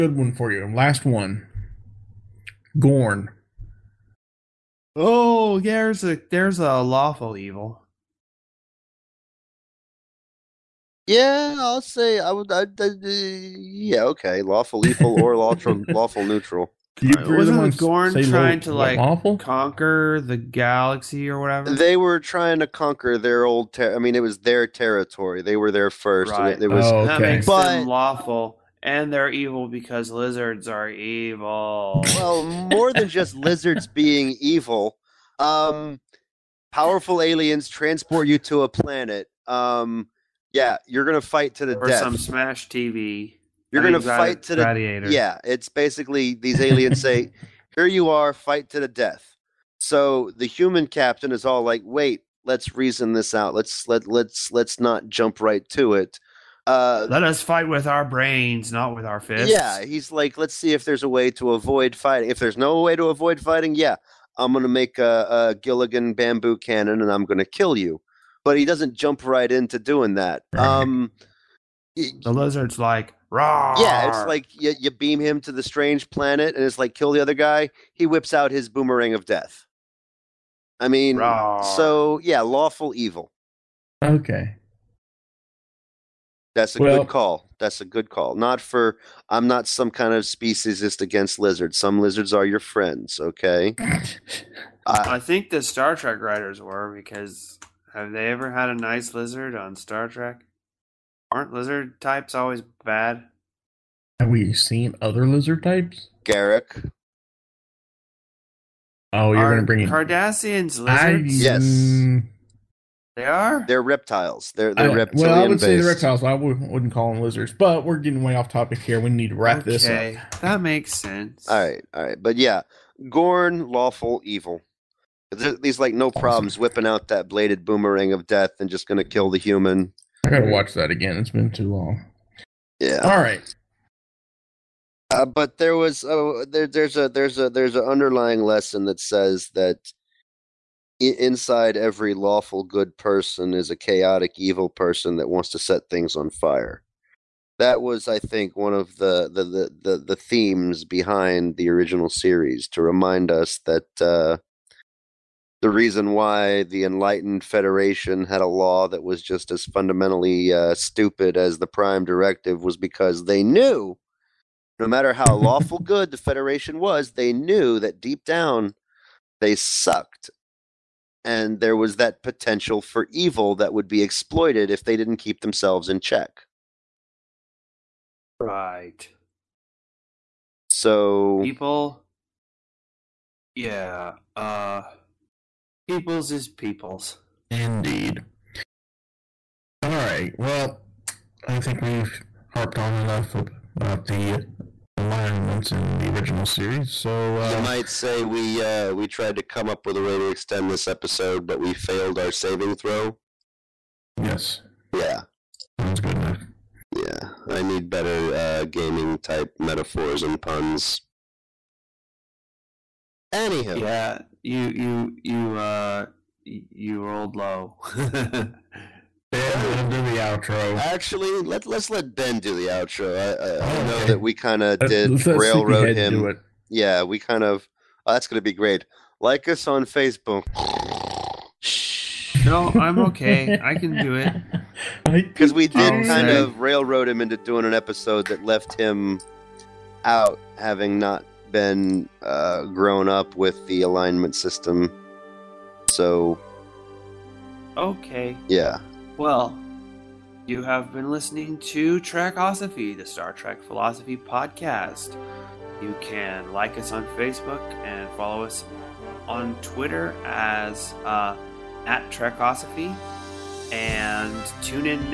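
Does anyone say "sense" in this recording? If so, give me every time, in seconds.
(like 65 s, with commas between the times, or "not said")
120 s.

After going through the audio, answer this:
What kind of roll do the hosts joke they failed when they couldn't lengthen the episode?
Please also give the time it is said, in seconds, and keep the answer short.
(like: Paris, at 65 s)
Saving throw, at 202 s.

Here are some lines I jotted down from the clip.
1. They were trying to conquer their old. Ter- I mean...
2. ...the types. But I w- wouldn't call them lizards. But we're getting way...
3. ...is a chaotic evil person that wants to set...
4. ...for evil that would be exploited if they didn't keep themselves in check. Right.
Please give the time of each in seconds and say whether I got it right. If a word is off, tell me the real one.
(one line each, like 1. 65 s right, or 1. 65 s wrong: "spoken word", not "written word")
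1. 21 s right
2. 115 s wrong: "reptiles", not "types"
3. 143 s right
4. 172 s right.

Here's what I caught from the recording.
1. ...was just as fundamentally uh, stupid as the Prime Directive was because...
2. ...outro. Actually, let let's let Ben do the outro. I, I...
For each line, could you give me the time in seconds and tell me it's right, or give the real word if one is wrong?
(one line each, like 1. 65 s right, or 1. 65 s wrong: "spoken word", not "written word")
1. 159 s right
2. 220 s right.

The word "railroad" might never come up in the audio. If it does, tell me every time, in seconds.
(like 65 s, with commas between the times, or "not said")
225 s, 236 s.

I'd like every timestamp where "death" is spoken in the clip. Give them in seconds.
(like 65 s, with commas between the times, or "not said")
41 s, 48 s, 79 s, 128 s.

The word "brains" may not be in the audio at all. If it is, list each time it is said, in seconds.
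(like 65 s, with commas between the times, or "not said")
58 s.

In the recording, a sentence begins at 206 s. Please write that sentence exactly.
Yeah, I need better uh, gaming type metaphors and puns.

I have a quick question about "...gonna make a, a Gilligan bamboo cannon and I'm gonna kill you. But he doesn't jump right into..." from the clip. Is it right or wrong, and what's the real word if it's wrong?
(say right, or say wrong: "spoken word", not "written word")
right.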